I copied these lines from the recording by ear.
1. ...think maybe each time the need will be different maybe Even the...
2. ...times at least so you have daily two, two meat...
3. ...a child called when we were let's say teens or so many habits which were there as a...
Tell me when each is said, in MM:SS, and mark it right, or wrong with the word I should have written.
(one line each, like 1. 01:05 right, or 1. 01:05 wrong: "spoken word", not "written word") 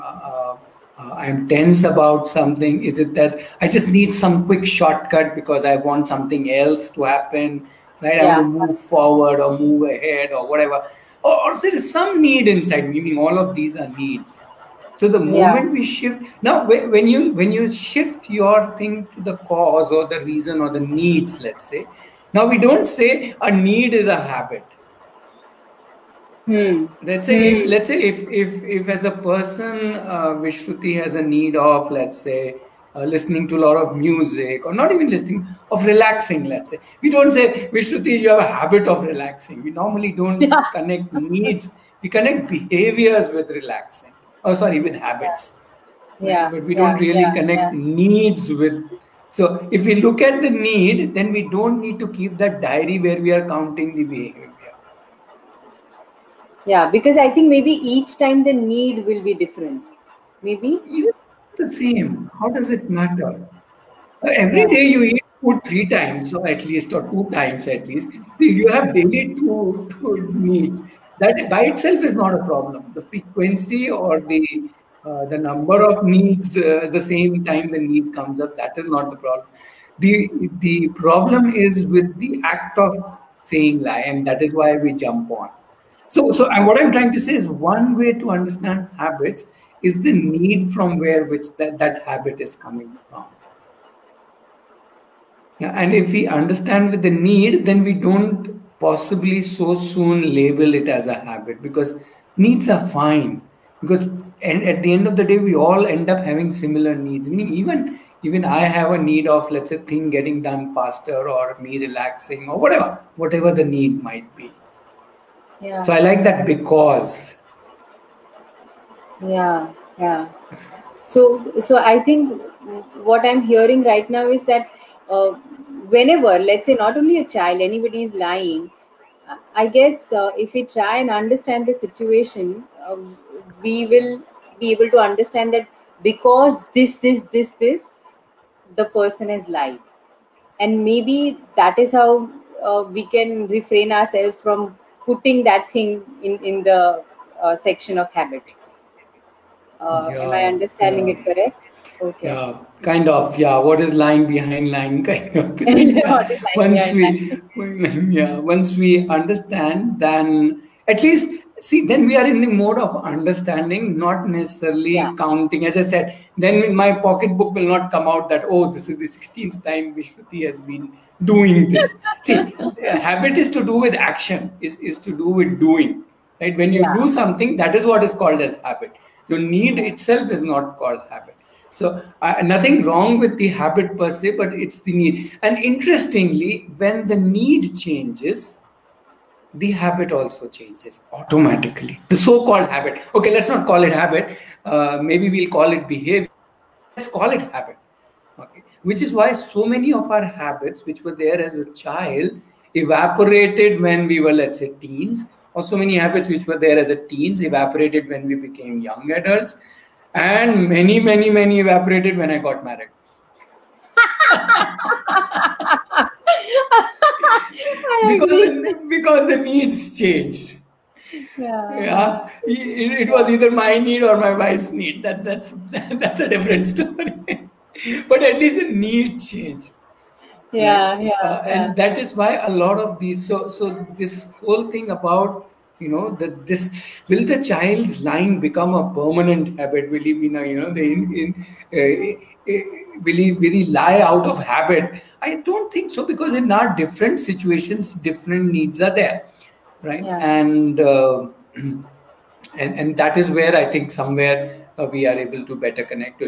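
1. 00:57 right
2. 01:07 right
3. 03:21 wrong: "evaporated", not "called".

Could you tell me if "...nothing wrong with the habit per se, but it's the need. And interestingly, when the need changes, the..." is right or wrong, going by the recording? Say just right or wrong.
right.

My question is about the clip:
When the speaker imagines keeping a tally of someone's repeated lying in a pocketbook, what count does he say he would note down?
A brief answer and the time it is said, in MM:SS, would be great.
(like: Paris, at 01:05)
16th time, at 02:49.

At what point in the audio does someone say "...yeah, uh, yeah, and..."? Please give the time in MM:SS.
03:50.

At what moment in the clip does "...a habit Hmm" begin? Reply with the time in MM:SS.
00:24.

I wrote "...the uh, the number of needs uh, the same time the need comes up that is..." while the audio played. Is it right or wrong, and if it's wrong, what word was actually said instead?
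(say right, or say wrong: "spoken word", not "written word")
right.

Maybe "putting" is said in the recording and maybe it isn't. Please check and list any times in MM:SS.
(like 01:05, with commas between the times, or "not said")
02:25.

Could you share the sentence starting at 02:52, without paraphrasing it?
See, habit is to do with action, is, is to do with doing.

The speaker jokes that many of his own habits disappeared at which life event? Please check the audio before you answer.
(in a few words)
got married.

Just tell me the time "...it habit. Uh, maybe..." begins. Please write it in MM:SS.
03:13.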